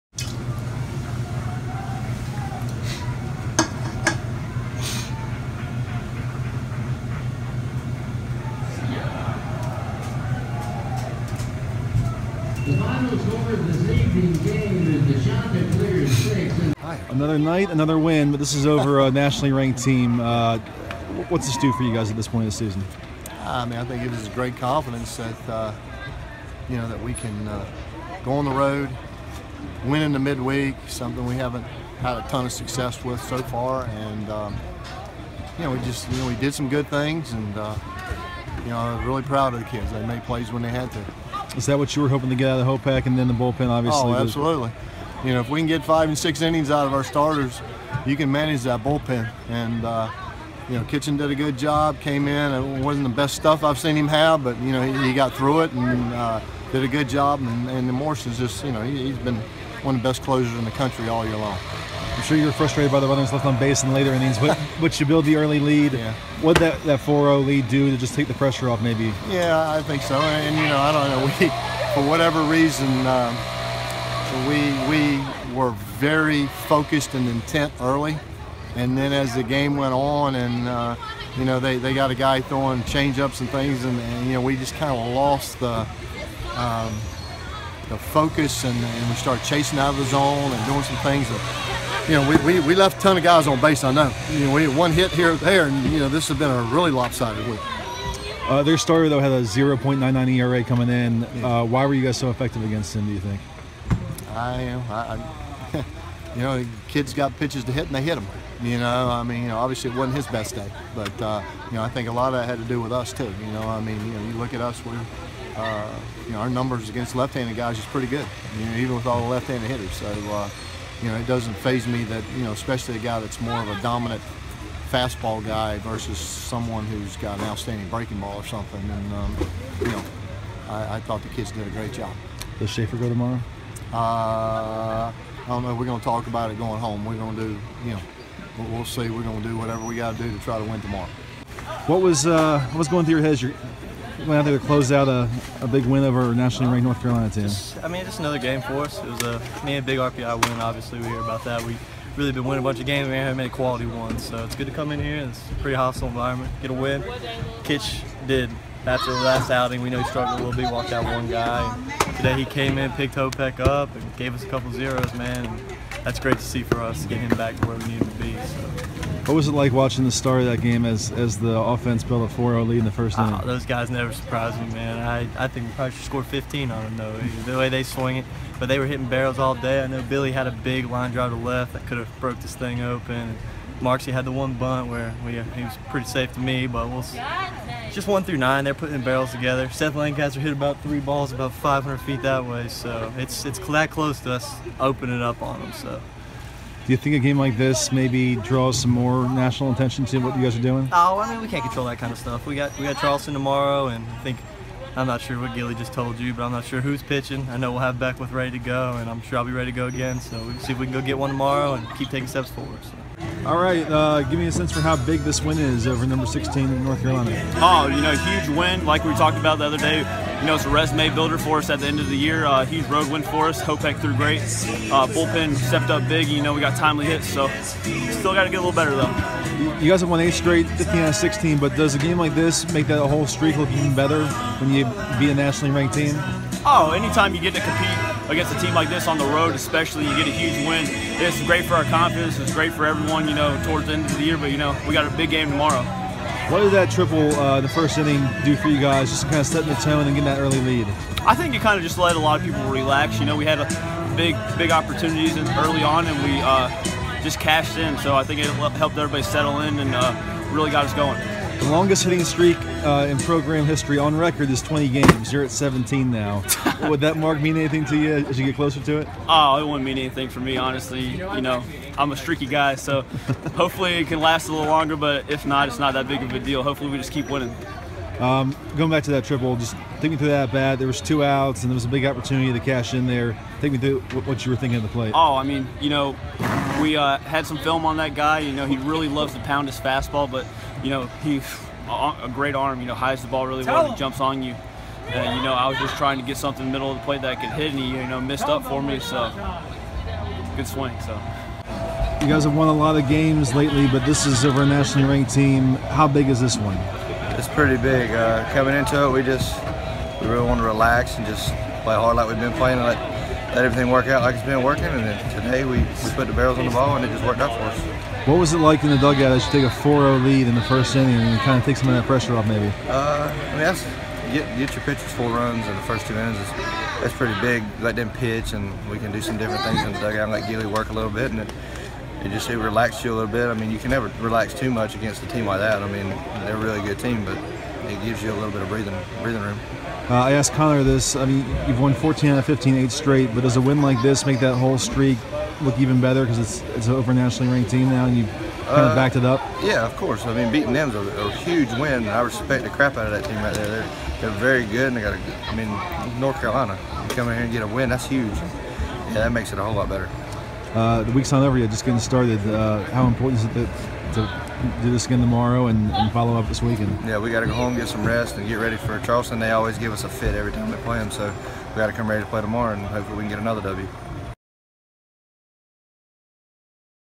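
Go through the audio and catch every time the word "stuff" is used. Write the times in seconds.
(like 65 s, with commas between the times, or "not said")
53 s, 202 s.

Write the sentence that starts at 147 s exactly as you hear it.
Just, I mean, just another game for us.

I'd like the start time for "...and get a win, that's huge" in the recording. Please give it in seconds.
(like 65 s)
357 s.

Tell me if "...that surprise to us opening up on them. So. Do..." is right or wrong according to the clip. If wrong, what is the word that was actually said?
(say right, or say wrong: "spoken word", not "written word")
wrong: "close", not "surprise".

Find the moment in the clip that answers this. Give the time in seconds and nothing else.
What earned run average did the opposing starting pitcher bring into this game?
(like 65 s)
99 s.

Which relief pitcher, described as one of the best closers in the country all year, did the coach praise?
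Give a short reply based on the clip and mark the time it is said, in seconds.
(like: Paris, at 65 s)
Morrison, at 57 s.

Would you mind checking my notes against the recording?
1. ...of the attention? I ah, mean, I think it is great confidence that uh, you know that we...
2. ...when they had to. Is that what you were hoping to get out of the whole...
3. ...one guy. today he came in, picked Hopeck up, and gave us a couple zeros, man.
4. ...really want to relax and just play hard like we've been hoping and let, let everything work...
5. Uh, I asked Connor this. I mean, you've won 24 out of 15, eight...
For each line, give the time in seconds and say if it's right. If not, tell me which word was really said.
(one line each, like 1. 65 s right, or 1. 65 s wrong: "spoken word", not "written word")
1. 22 s wrong: "season", not "attention"
2. 40 s right
3. 161 s right
4. 310 s wrong: "playing", not "hoping"
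5. 340 s wrong: "14", not "24".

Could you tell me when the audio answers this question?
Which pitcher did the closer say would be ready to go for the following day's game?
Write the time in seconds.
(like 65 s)
207 s.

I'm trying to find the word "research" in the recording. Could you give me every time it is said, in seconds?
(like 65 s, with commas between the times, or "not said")
not said.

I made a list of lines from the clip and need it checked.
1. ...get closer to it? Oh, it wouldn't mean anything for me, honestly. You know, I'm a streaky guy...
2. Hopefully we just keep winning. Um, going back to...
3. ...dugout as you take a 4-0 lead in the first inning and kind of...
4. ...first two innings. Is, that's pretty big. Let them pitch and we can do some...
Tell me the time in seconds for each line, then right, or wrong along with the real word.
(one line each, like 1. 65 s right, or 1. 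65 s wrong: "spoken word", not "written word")
1. 268 s right
2. 276 s right
3. 318 s right
4. 325 s right.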